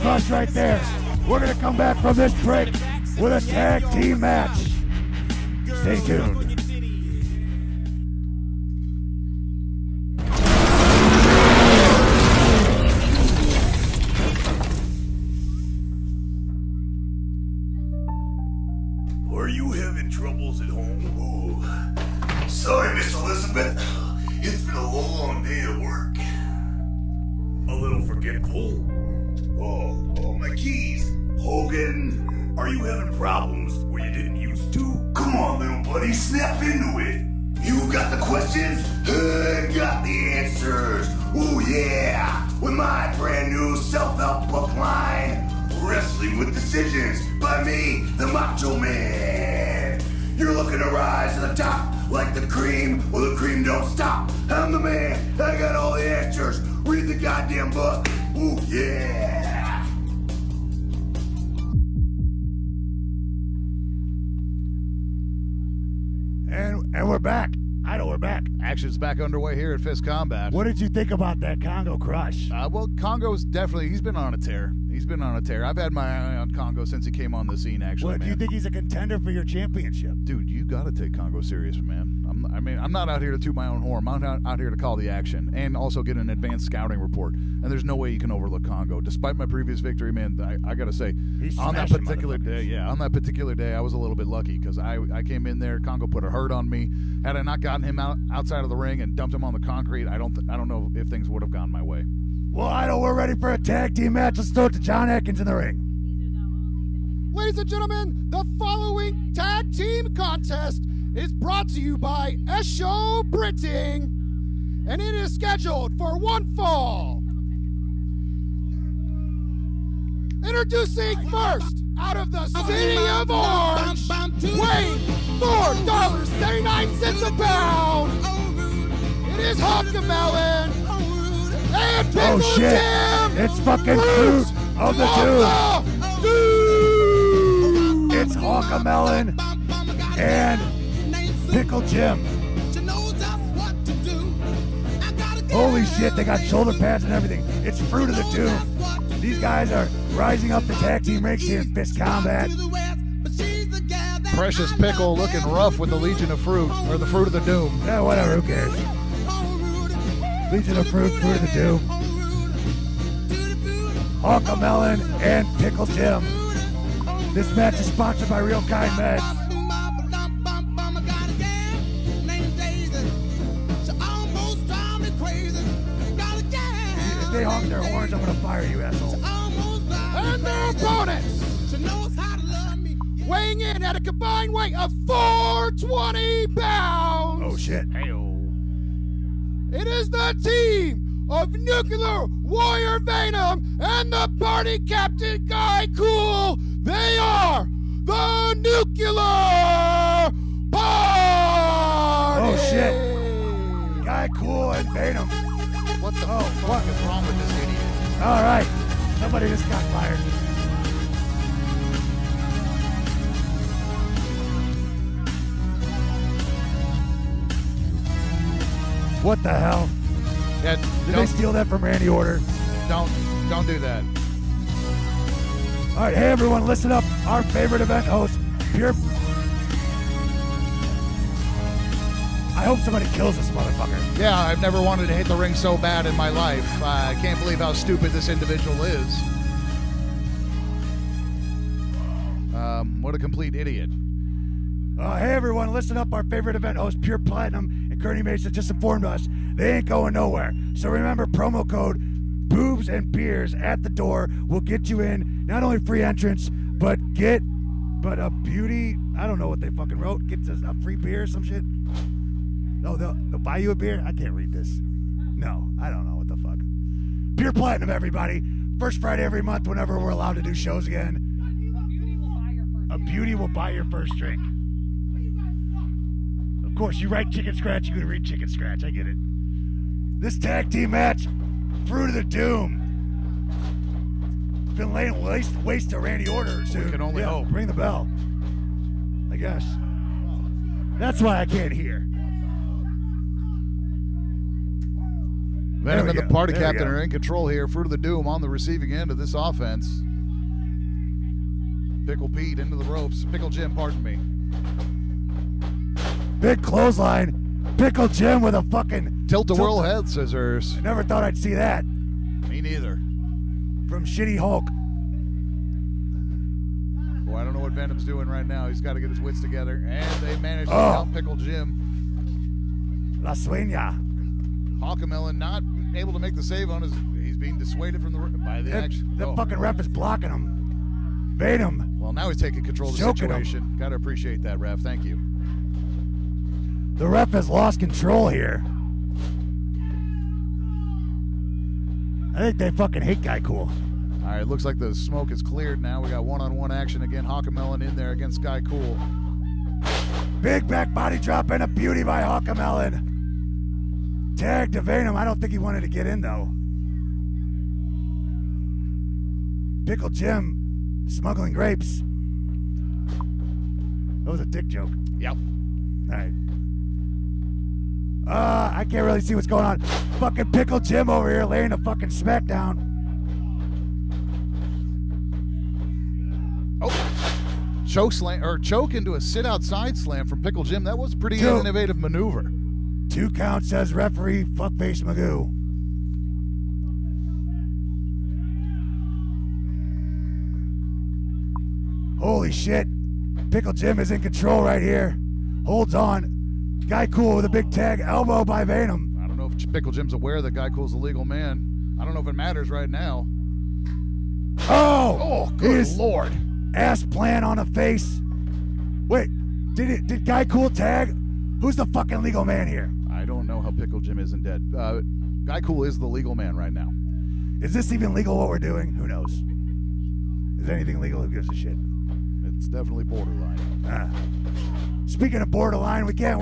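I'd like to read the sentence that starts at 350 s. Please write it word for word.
Big back body drop and a beauty by Hawkemelon.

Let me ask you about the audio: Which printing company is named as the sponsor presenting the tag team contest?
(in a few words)
Esho Printing.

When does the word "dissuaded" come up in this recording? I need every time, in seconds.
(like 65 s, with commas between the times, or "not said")
327 s.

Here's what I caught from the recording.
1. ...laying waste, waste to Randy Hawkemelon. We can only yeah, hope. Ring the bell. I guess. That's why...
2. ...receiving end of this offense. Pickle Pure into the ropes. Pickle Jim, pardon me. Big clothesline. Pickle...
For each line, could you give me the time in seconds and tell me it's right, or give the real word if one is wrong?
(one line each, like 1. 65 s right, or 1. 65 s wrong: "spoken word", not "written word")
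1. 284 s wrong: "Order", not "Hawkemelon"
2. 298 s wrong: "Pete", not "Pure".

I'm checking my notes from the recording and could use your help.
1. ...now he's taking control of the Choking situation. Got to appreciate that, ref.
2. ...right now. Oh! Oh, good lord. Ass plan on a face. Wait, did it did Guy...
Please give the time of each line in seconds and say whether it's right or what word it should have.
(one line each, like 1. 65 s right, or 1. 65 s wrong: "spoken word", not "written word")
1. 332 s right
2. 402 s right.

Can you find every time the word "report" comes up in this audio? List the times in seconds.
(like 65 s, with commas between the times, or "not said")
87 s.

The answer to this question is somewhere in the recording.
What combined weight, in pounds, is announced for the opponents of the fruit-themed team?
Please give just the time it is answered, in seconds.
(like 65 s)
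185 s.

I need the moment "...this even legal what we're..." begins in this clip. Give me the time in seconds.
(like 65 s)
417 s.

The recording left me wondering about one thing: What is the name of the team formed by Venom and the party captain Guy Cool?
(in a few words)
Nuclear Party.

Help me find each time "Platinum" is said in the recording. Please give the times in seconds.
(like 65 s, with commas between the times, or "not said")
247 s, 267 s.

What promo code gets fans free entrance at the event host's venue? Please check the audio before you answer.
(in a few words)
boobs and beers.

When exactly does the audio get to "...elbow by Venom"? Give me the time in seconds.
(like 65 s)
398 s.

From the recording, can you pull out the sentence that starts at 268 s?
First Friday every month, whenever we're allowed to do shows again.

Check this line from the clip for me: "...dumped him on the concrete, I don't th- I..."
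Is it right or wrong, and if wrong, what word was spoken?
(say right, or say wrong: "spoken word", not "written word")
right.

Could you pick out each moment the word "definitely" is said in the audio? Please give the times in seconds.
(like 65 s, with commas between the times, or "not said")
73 s, 422 s.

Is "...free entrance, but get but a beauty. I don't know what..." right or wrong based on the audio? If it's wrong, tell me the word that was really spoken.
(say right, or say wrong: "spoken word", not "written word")
right.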